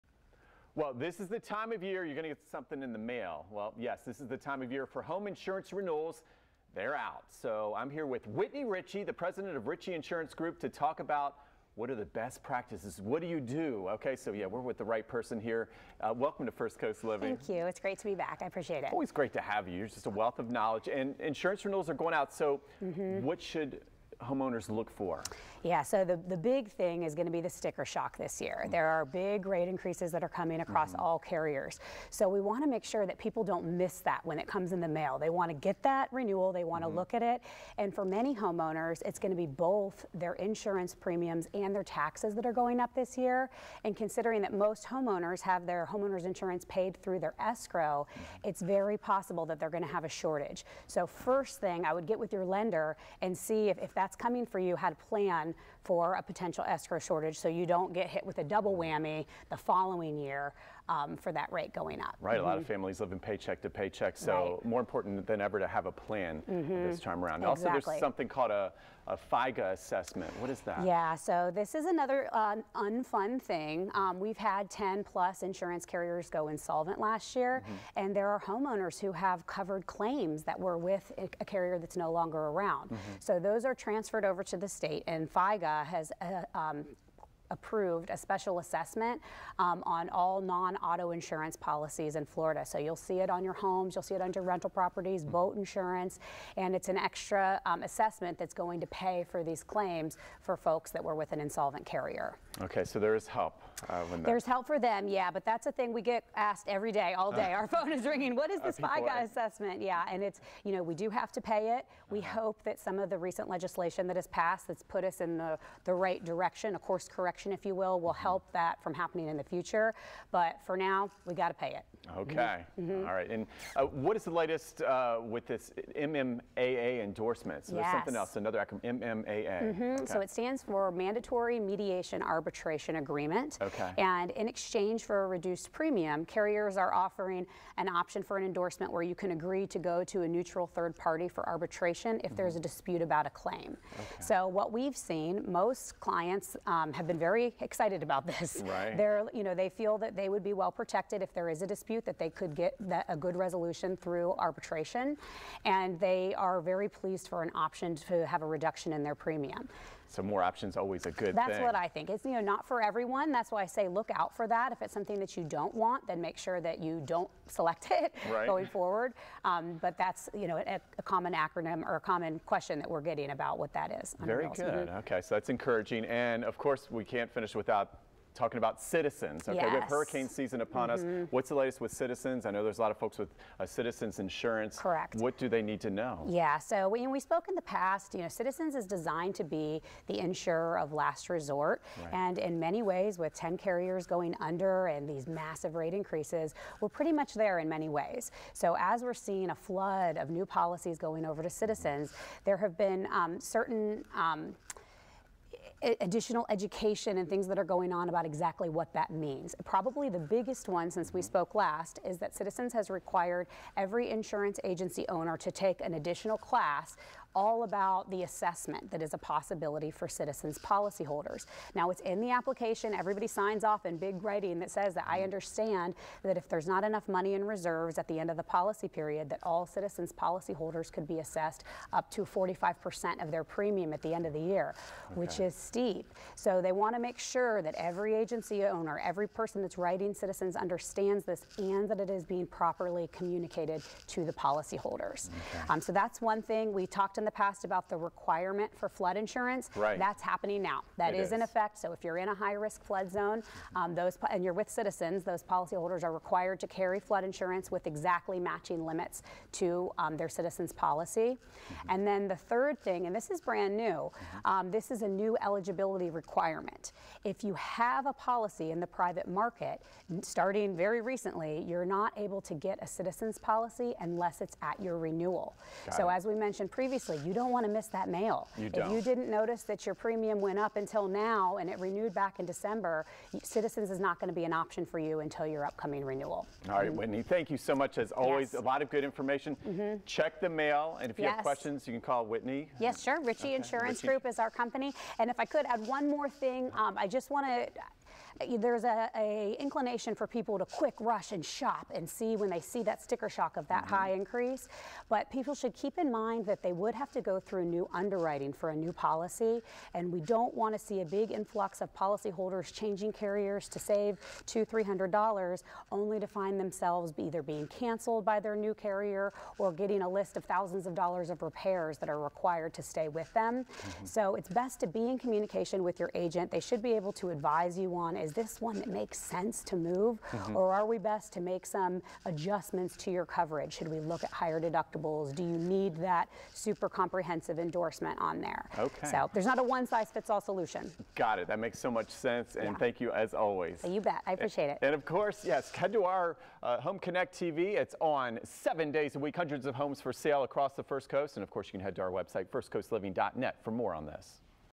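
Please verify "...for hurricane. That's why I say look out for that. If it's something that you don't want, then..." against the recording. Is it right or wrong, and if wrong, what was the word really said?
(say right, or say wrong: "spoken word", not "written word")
wrong: "everyone", not "hurricane".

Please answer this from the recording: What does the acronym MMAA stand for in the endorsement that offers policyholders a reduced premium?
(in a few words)
Mandatory Mediation Arbitration Agreement.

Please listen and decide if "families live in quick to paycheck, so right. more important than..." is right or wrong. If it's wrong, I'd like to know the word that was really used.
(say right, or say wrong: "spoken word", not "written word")
wrong: "paycheck", not "quick".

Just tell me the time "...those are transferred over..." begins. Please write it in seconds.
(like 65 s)
83 s.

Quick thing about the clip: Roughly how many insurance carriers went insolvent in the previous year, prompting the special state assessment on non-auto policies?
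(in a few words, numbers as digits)
10 plus.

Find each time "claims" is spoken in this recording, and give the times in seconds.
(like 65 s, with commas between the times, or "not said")
79 s, 99 s, 143 s.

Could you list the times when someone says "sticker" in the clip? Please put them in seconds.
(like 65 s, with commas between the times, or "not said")
27 s, 303 s.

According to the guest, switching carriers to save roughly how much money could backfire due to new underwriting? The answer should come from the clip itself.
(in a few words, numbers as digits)
200 or 300 dollars.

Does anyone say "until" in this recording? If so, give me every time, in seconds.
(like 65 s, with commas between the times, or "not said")
280 s, 285 s.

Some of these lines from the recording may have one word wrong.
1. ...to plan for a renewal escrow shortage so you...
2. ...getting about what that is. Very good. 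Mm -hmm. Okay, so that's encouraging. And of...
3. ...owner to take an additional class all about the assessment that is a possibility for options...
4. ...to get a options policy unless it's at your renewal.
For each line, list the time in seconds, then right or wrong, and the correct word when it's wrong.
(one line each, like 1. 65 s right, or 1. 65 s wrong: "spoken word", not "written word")
1. 54 s wrong: "potential", not "renewal"
2. 172 s right
3. 215 s wrong: "citizens", not "options"
4. 272 s wrong: "citizens", not "options".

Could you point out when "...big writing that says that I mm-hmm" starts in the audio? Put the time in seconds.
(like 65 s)
223 s.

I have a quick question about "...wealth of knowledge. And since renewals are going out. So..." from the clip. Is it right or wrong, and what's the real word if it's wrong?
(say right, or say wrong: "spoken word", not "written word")
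wrong: "insurance", not "since".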